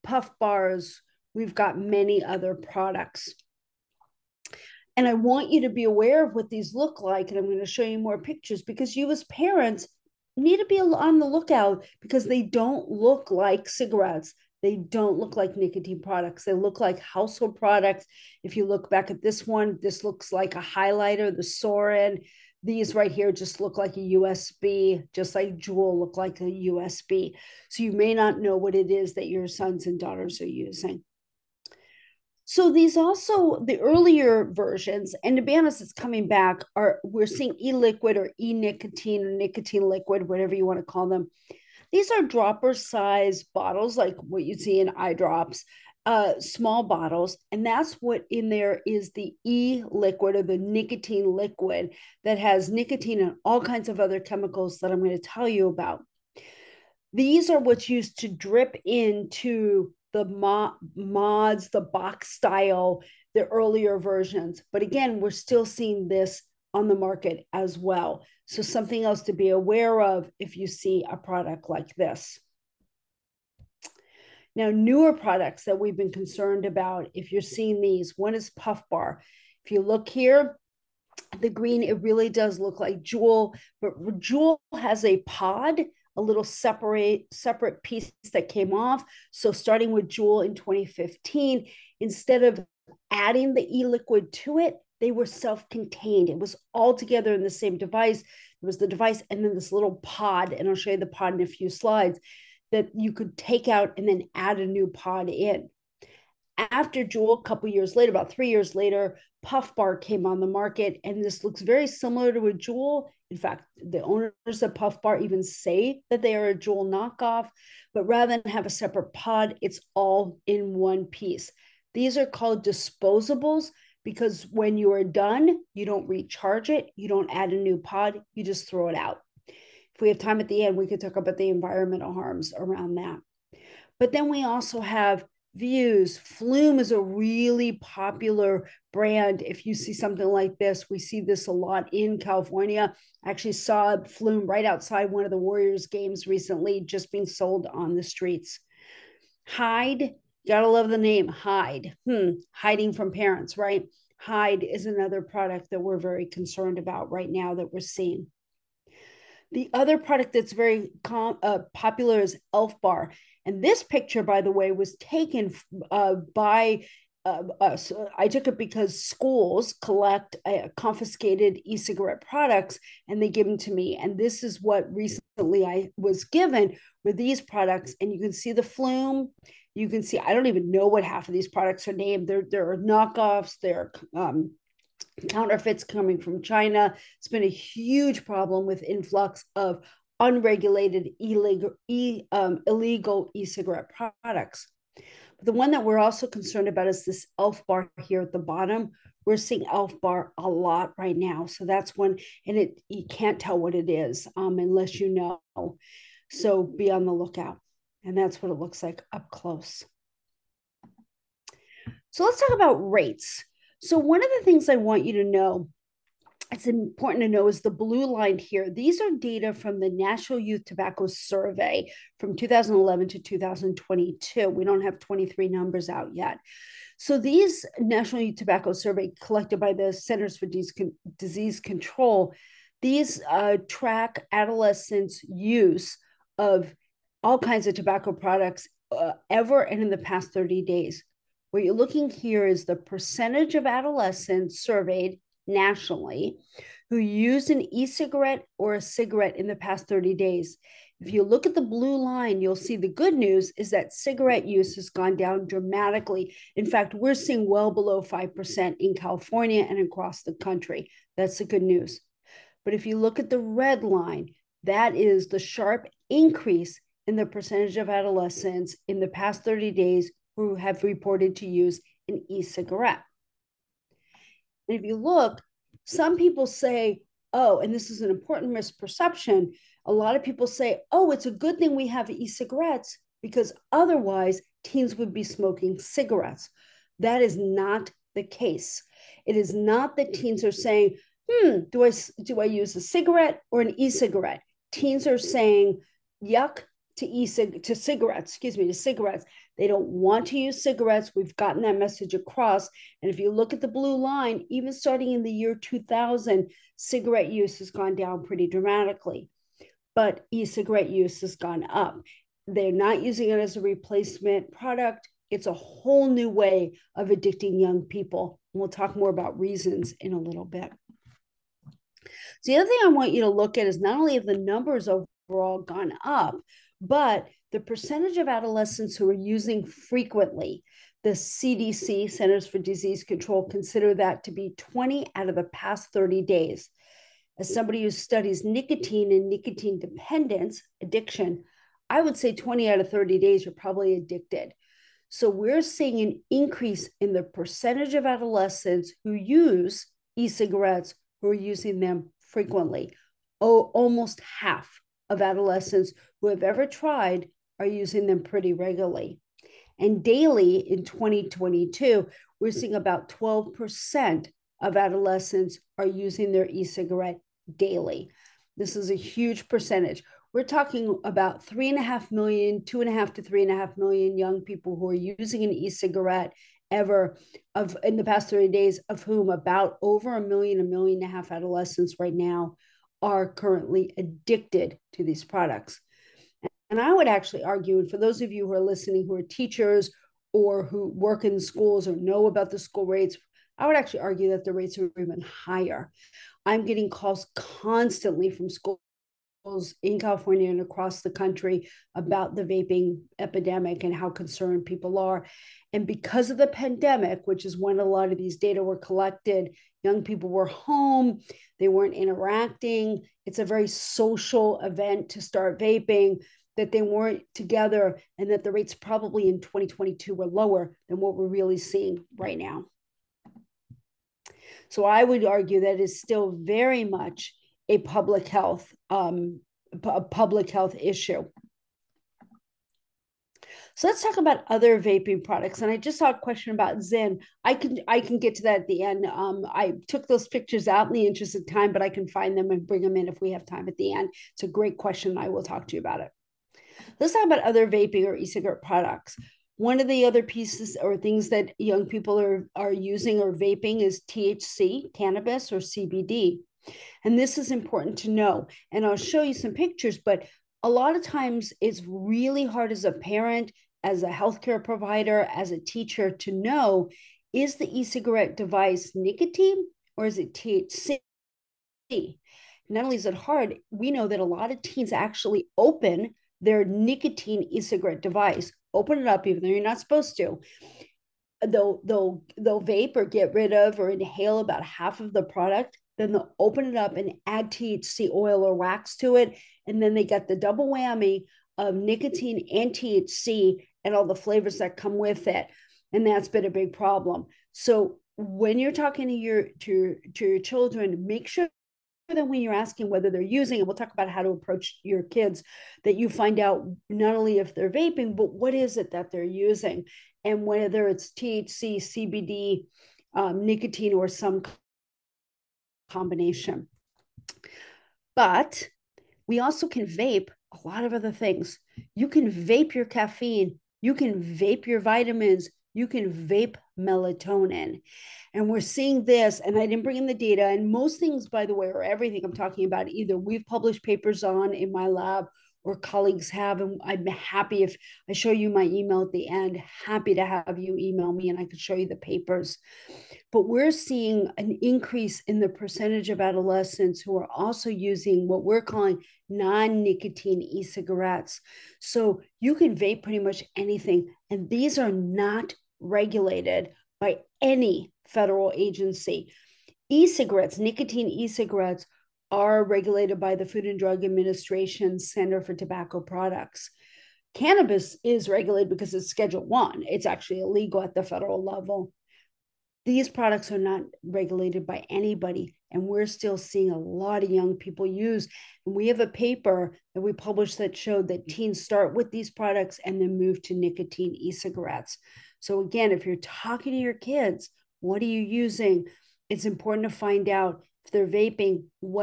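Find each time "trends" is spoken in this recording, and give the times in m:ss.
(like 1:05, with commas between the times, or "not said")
not said.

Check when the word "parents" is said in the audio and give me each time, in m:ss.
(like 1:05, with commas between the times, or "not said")
0:09, 2:33, 7:42.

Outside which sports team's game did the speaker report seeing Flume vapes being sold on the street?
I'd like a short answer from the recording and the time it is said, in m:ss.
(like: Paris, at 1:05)
the Warriors, at 2:25.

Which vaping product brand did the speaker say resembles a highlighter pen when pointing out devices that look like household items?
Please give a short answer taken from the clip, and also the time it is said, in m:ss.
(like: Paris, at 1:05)
Suorin, at 0:21.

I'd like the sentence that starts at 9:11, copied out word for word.
So you can vape pretty much anything.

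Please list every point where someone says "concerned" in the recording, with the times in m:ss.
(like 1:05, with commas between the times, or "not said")
1:16, 2:36, 3:16, 6:44.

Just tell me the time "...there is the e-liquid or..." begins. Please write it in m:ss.
0:48.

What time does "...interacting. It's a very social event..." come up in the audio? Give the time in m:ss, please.
6:51.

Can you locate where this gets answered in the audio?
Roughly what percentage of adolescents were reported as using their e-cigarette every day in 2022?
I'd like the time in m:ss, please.
6:03.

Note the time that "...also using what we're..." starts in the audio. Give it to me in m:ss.
9:07.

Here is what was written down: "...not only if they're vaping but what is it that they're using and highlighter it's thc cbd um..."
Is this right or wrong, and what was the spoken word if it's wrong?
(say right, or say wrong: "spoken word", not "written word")
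wrong: "whether", not "highlighter".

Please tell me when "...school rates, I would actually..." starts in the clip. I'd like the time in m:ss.
6:32.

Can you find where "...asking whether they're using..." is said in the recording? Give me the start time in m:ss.
8:22.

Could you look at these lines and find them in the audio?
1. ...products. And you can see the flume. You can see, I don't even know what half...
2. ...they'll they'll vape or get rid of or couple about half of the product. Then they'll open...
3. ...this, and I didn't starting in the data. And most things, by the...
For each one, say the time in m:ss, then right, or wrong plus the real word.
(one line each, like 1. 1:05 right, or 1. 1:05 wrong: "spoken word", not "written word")
1. 2:57 right
2. 8:01 wrong: "inhale", not "couple"
3. 8:49 wrong: "bring", not "starting".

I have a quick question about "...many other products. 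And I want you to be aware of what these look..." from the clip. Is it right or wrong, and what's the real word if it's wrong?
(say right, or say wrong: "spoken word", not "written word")
right.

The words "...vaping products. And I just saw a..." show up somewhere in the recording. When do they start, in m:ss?
7:14.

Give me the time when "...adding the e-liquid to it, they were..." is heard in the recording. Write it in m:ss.
1:33.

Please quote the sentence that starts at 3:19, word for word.
We're seeing elf bar a lot right now.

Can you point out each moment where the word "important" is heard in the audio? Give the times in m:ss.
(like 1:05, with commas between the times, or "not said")
3:36, 4:38, 7:37, 9:49.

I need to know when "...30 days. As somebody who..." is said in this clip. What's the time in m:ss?
5:35.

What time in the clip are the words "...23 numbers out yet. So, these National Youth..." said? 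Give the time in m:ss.
3:44.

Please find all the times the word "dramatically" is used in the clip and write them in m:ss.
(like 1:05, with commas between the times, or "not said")
4:15, 5:08.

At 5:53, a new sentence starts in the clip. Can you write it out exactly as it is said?
Oh, almost half of adolescents who have ever tried are using them pretty regularly.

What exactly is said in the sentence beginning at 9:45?
So, again, if you're talking to your kids, what are you using?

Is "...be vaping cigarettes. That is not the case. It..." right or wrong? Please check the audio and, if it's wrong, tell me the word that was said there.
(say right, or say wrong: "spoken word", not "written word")
wrong: "smoking", not "vaping".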